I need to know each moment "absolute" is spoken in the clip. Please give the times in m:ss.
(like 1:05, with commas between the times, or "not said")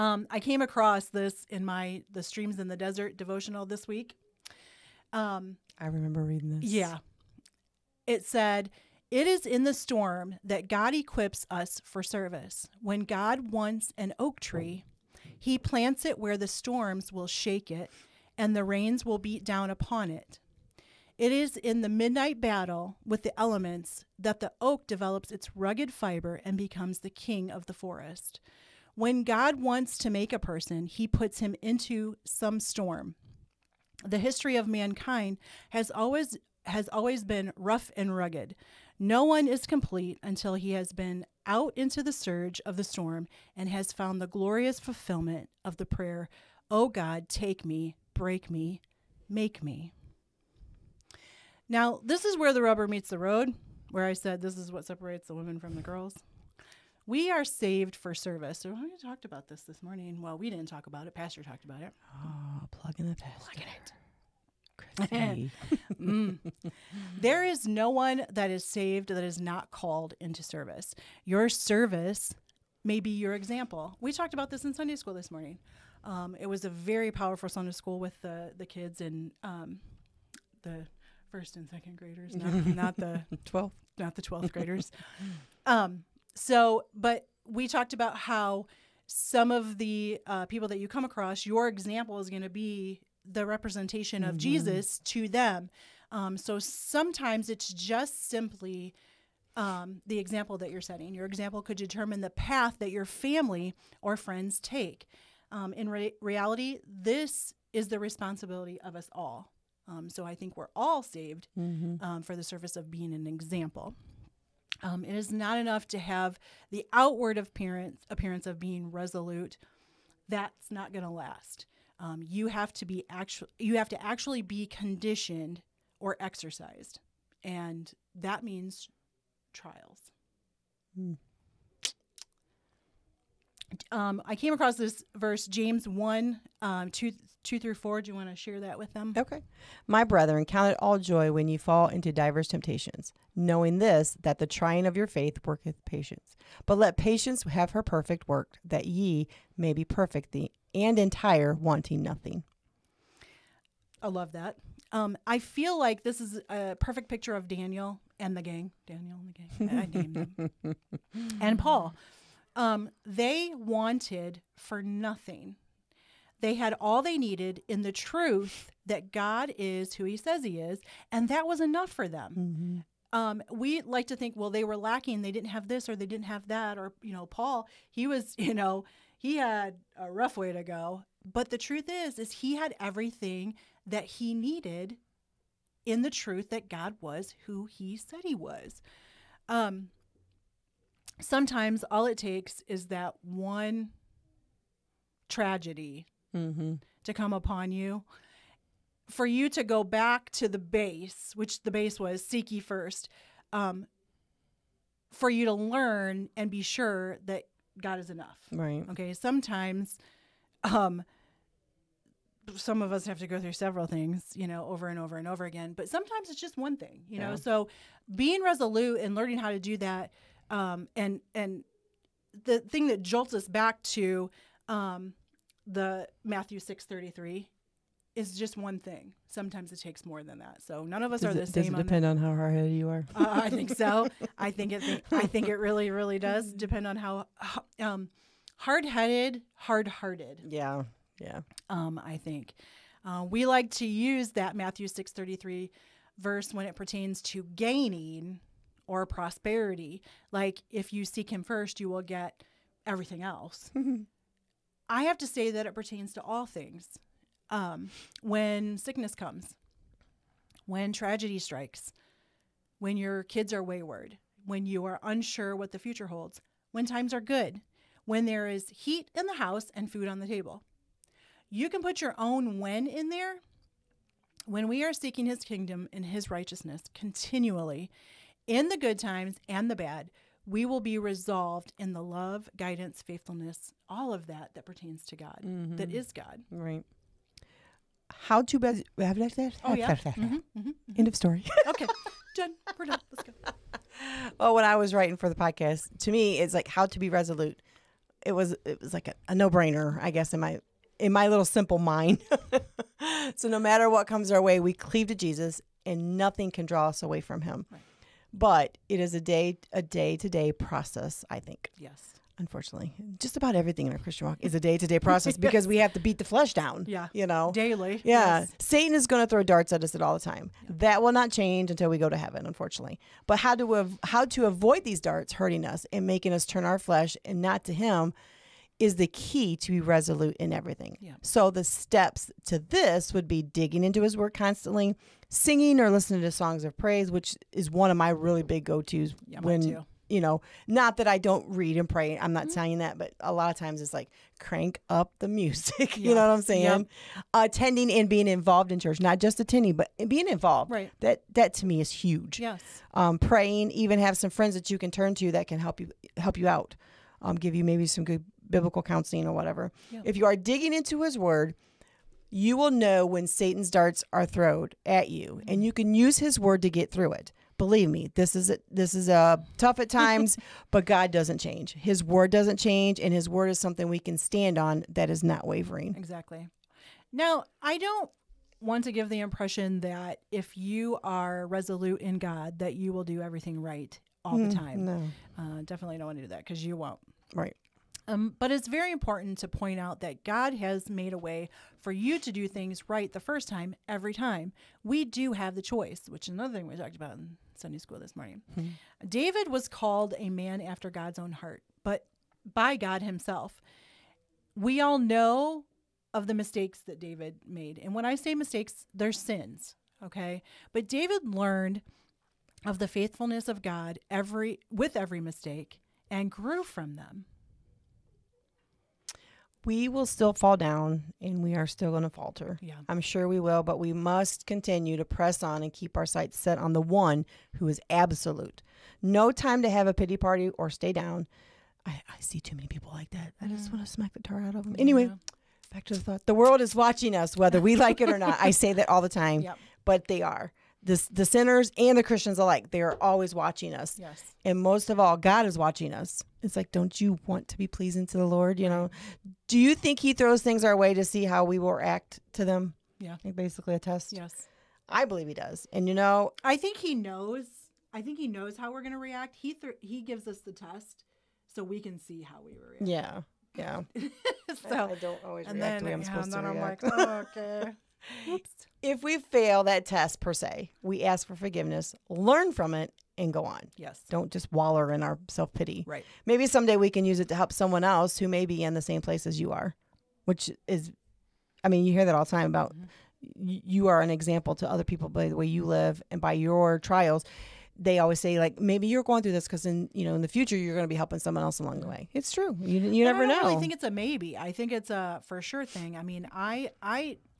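7:07.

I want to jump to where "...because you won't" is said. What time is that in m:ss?
6:26.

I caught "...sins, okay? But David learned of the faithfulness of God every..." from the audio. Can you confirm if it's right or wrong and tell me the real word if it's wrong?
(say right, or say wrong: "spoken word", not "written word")
right.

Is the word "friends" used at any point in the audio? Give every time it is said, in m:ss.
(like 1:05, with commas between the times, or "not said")
1:44, 5:54.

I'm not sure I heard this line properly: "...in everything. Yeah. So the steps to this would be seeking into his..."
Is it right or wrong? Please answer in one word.
wrong.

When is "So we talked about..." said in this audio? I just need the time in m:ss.
0:58.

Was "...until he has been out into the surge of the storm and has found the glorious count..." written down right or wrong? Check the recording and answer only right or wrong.
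wrong.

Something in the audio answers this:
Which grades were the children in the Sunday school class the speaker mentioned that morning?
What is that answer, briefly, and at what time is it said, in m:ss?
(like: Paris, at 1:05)
first and second, at 1:21.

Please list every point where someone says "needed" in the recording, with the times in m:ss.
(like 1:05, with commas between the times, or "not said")
2:47, 3:04.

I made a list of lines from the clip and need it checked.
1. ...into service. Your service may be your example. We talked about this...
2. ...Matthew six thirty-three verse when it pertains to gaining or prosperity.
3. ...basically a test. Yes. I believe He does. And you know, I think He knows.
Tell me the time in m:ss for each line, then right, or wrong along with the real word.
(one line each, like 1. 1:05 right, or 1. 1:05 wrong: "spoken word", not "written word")
1. 1:10 right
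2. 4:04 right
3. 7:33 right.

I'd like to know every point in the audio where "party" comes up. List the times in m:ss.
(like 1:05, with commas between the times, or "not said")
7:10.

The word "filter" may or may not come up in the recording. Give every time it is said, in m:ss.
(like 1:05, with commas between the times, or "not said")
not said.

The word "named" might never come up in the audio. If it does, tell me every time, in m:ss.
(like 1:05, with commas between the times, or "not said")
2:39.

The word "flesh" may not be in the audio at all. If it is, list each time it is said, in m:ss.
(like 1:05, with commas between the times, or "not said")
5:16, 5:26.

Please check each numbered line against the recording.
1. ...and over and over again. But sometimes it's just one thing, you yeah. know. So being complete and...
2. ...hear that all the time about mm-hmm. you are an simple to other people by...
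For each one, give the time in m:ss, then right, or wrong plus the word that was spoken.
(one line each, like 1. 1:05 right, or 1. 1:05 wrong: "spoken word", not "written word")
1. 3:34 wrong: "resolute", not "complete"
2. 8:01 wrong: "example", not "simple".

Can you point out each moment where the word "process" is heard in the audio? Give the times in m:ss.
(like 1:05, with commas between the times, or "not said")
5:10, 5:14.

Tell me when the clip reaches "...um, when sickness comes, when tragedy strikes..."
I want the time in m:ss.
4:17.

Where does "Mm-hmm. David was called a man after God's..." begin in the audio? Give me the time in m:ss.
6:38.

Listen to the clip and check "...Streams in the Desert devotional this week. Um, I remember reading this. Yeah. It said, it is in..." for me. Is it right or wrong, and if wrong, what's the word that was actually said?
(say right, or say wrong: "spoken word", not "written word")
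right.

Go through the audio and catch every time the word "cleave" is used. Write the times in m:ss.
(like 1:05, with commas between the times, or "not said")
5:04.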